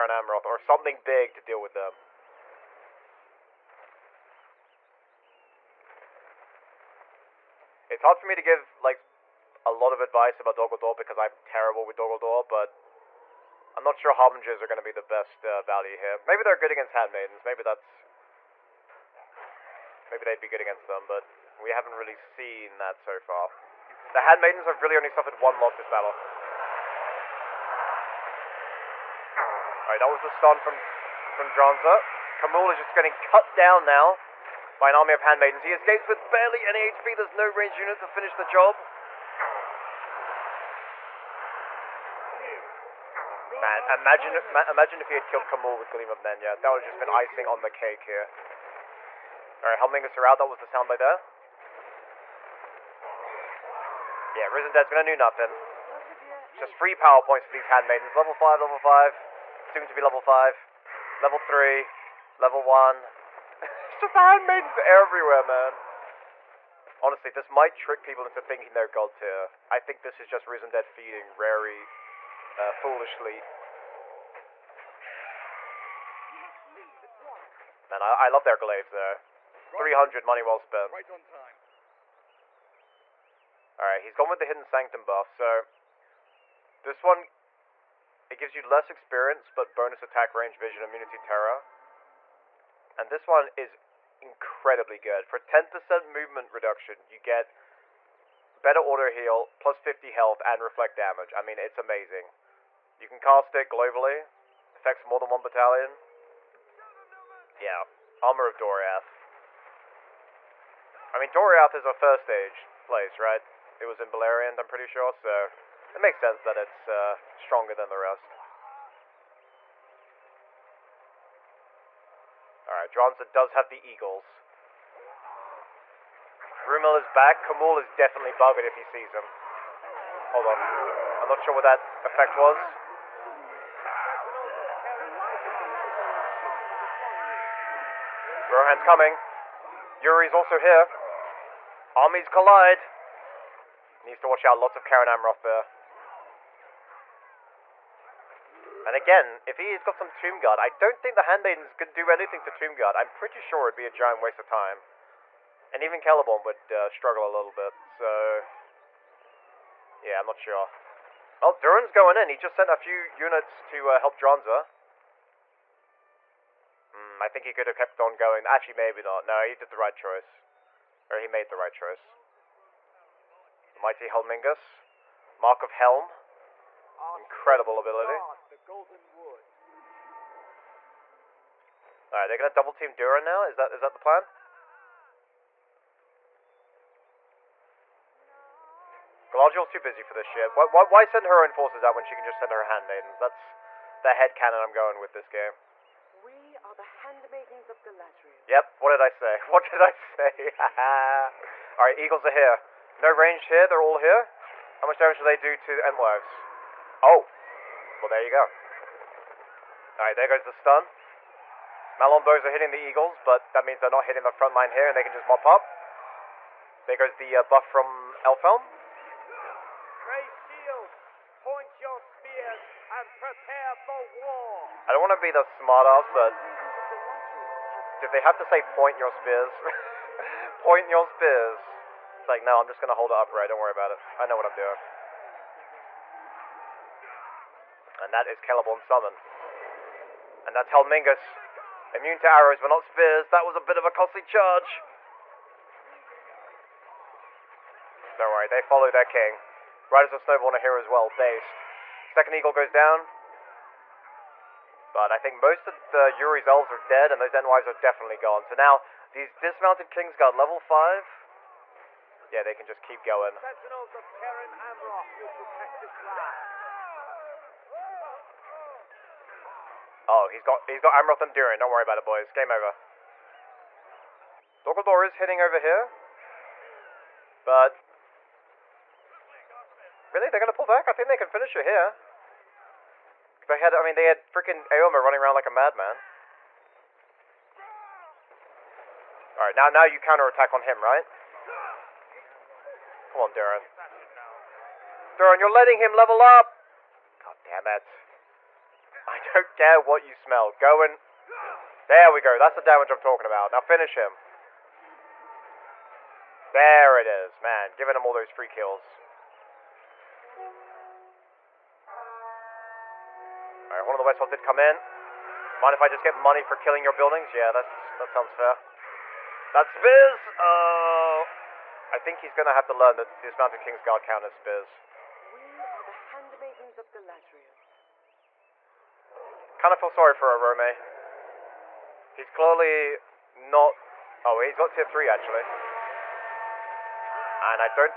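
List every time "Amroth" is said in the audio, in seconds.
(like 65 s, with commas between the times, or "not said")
0 s, 145 s, 264 s, 270 s.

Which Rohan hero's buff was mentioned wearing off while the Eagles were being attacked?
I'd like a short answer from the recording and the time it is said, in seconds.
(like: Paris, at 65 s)
Elfhelm, at 218 s.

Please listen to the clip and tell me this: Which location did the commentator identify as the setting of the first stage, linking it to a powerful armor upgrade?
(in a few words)
Beleriand.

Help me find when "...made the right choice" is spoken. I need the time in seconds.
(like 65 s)
171 s.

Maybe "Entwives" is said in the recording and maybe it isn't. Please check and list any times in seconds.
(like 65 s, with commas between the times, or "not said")
205 s, 257 s.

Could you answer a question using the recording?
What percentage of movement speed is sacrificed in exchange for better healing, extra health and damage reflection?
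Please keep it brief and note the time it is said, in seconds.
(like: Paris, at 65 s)
10%, at 95 s.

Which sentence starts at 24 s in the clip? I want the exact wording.
The Handmaidens have really only suffered one loss this battle.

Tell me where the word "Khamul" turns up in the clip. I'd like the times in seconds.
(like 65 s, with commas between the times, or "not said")
32 s, 45 s, 127 s.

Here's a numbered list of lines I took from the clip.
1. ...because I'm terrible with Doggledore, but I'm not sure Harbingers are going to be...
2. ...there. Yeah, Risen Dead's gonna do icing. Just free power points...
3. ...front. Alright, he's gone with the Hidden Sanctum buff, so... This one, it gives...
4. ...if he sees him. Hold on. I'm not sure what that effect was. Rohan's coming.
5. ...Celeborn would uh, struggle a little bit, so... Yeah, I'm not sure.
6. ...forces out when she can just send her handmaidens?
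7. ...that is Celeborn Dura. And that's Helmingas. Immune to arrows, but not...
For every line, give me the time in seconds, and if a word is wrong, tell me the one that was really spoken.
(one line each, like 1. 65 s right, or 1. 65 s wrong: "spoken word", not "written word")
1. 10 s right
2. 50 s wrong: "nothing", not "icing"
3. 80 s wrong: "spent", not "front"
4. 128 s right
5. 156 s right
6. 191 s right
7. 238 s wrong: "Summon", not "Dura".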